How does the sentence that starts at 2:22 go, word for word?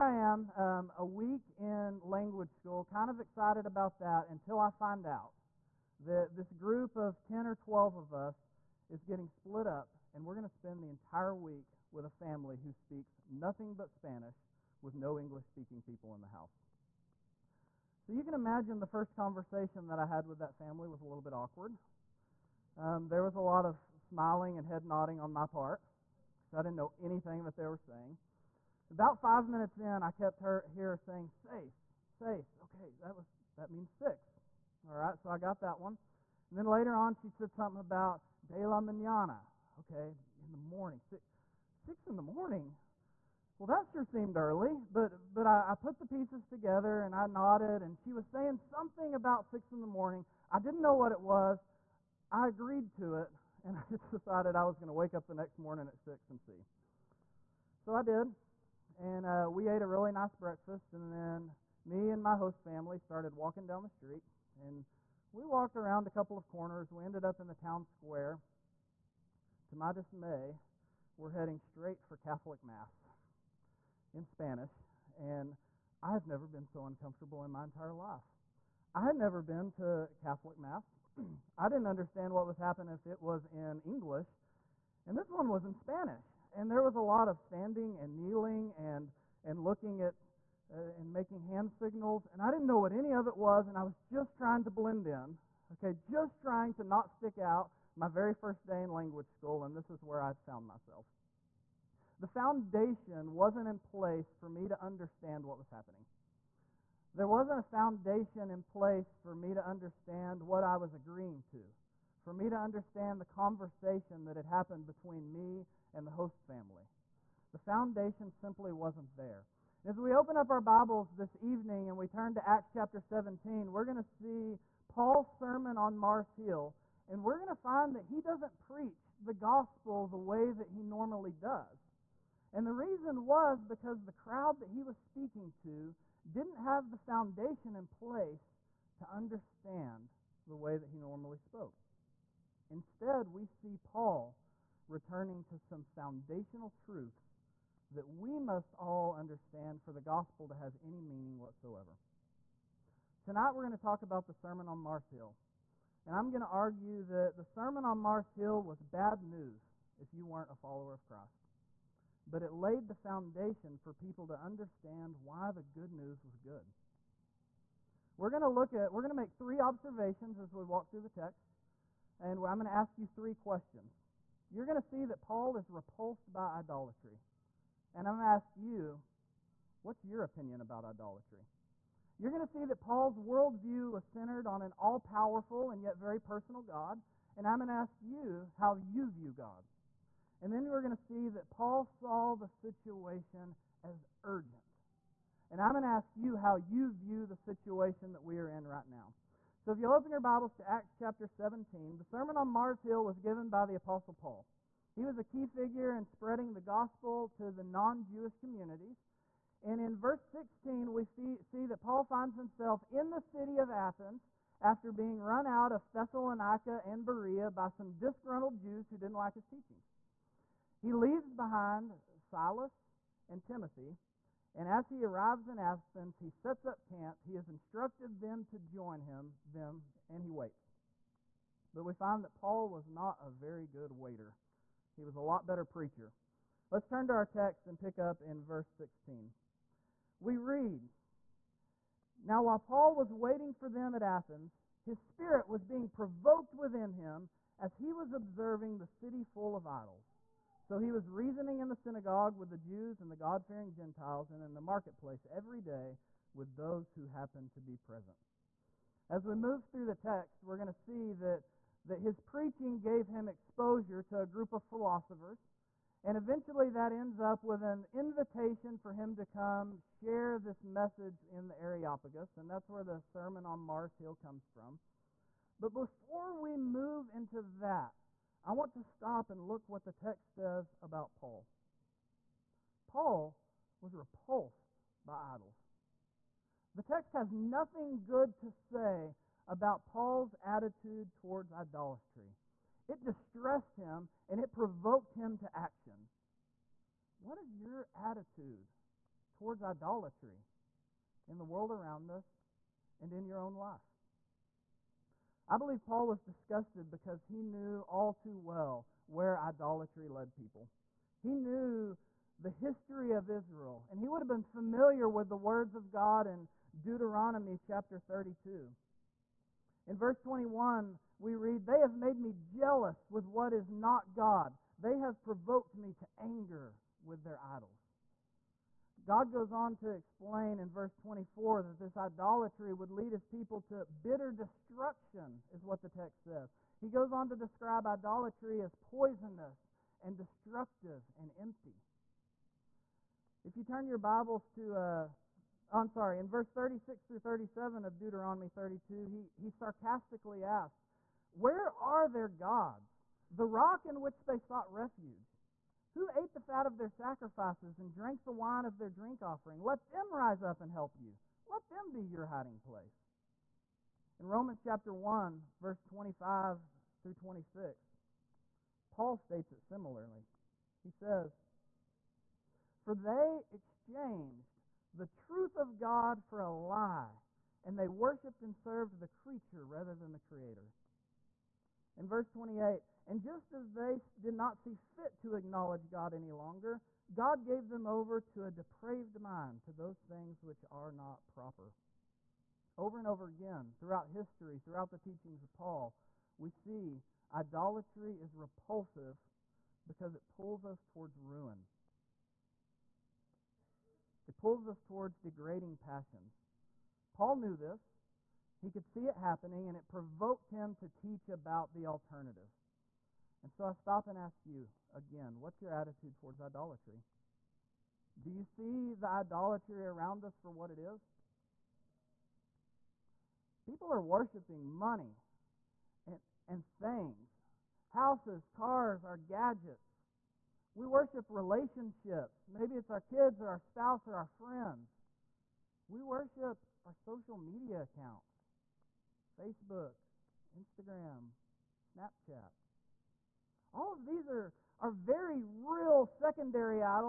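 Instead, we see Paul returning to some foundational truths that we must all understand for the gospel to have any meaning whatsoever.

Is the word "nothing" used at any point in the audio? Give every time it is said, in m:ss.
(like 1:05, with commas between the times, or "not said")
0:13, 4:47.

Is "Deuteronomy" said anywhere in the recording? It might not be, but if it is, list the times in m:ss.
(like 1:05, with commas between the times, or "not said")
5:16, 5:47.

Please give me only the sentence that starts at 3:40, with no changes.
He leaves behind Silas and Timothy, and as he arrives in Athens, he sets up camp.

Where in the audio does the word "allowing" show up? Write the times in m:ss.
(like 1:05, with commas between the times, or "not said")
not said.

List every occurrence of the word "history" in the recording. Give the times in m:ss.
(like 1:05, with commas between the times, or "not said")
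5:12, 6:34.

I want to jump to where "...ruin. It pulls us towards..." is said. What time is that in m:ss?
6:41.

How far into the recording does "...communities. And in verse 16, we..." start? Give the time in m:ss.
3:28.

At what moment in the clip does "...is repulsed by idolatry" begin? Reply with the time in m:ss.
2:55.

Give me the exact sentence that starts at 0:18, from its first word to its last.
So you can imagine the first conversation that I had with that family was a little bit awkward.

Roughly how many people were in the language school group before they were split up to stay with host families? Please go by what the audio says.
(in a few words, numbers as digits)
10 or 12.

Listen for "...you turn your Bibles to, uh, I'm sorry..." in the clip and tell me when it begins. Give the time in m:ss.
5:43.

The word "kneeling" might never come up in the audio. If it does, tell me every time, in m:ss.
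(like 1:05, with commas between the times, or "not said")
1:28.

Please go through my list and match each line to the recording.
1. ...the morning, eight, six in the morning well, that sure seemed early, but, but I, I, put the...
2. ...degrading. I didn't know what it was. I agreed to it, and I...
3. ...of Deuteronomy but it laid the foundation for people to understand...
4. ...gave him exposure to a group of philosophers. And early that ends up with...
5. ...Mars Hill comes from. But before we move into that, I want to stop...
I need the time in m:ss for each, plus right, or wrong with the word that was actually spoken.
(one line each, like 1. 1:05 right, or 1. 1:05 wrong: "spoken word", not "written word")
1. 0:40 wrong: "six", not "eight"
2. 0:49 wrong: "morning", not "degrading"
3. 2:40 wrong: "Christ", not "Deuteronomy"
4. 4:22 wrong: "eventually", not "early"
5. 4:33 right.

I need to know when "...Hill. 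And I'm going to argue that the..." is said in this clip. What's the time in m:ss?
2:35.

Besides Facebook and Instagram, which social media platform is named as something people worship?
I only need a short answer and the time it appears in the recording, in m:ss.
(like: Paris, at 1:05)
Snapchat, at 7:21.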